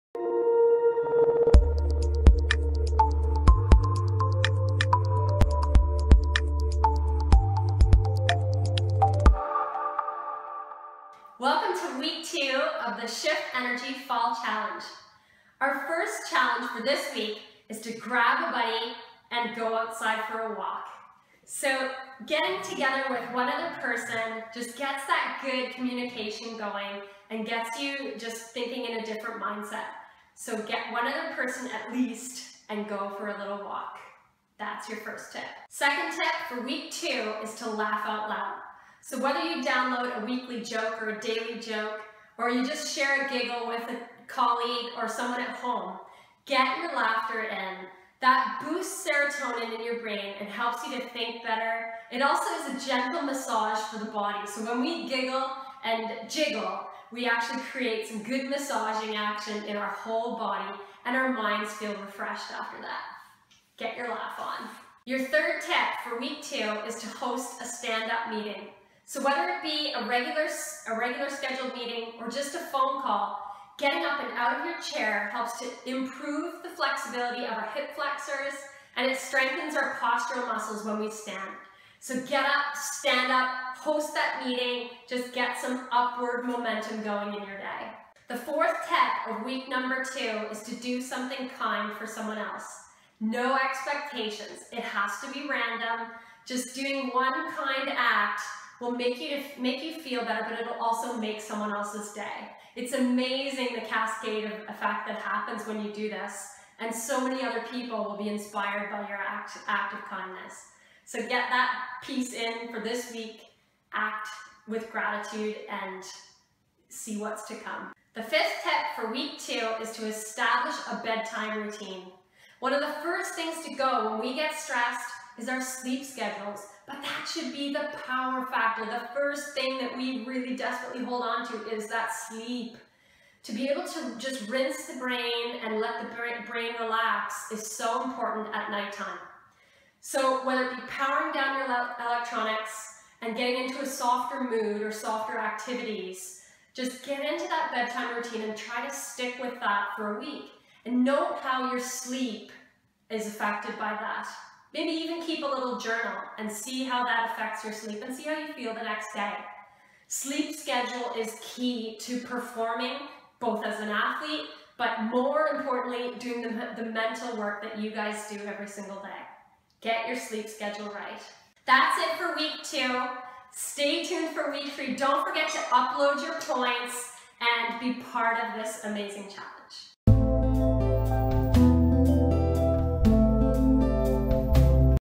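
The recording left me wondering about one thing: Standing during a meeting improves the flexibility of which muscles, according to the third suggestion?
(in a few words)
hip flexors.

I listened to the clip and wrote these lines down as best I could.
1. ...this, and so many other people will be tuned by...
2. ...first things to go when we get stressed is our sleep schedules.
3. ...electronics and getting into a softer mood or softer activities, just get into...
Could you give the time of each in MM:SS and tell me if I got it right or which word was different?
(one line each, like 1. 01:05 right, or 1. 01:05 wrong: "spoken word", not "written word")
1. 01:46 wrong: "inspired", not "tuned"
2. 02:03 right
3. 02:21 right.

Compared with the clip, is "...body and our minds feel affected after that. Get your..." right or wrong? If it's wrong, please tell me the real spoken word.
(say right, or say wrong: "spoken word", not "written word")
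wrong: "refreshed", not "affected".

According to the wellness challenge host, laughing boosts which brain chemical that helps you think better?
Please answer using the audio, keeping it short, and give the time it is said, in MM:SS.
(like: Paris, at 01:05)
serotonin, at 00:49.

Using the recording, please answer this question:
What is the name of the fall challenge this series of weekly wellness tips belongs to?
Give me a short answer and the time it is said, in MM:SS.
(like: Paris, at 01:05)
Shift Energy Fall Challenge, at 00:13.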